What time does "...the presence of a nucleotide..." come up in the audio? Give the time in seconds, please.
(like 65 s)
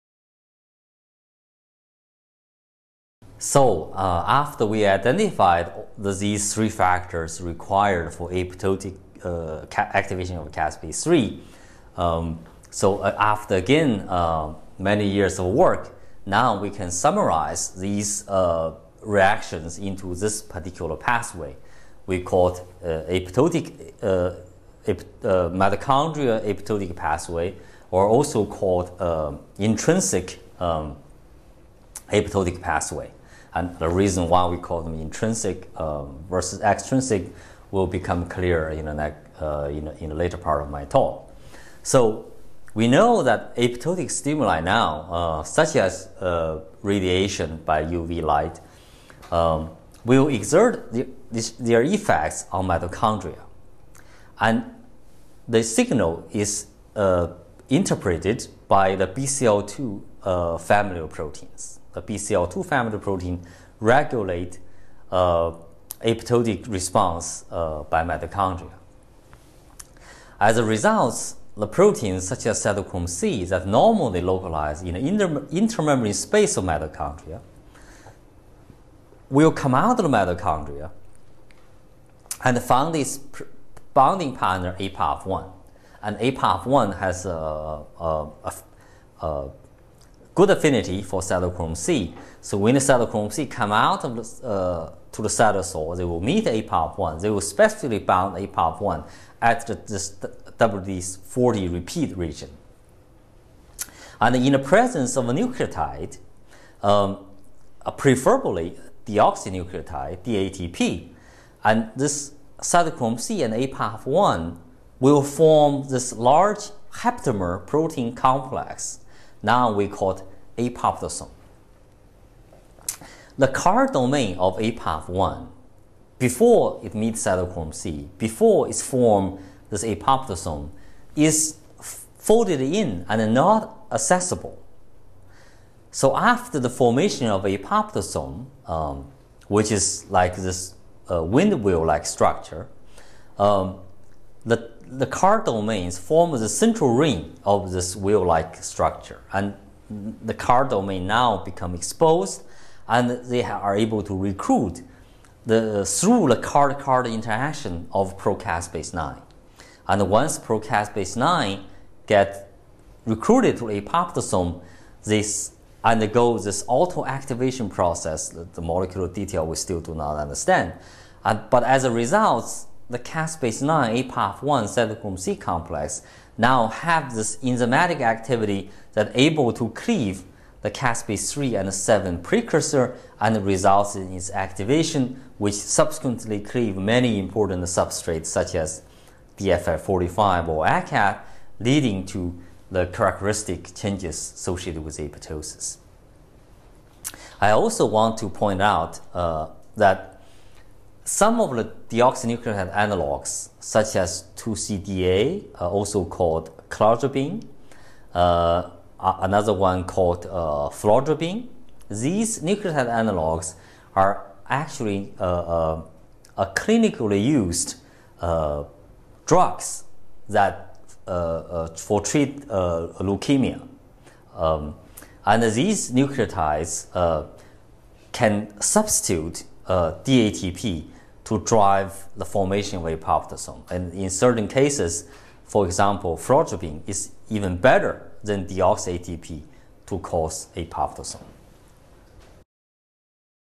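104 s.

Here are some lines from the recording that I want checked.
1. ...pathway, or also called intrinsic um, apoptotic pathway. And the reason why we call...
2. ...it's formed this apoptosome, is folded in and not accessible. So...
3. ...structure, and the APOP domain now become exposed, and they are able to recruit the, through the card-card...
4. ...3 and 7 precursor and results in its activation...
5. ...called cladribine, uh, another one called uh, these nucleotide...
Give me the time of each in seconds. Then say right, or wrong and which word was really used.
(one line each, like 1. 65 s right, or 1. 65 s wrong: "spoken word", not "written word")
1. 26 s right
2. 128 s right
3. 148 s wrong: "CARD", not "APOP"
4. 181 s right
5. 206 s right.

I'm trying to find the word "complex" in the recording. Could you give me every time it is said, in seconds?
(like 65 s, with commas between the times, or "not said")
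118 s, 175 s.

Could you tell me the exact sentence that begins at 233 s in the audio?
And in certain cases, for example, frotropin is even better than deoxy ATP to cause a apoptosis.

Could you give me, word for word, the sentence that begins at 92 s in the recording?
So when the cytochrome C come out of the, uh, to the cytosol, they will meet APAF1.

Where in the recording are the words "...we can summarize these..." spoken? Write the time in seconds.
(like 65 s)
16 s.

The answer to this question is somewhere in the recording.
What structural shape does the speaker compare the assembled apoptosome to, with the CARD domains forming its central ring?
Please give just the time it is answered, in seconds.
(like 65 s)
141 s.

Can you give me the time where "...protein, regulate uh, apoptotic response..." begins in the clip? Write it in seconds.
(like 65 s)
62 s.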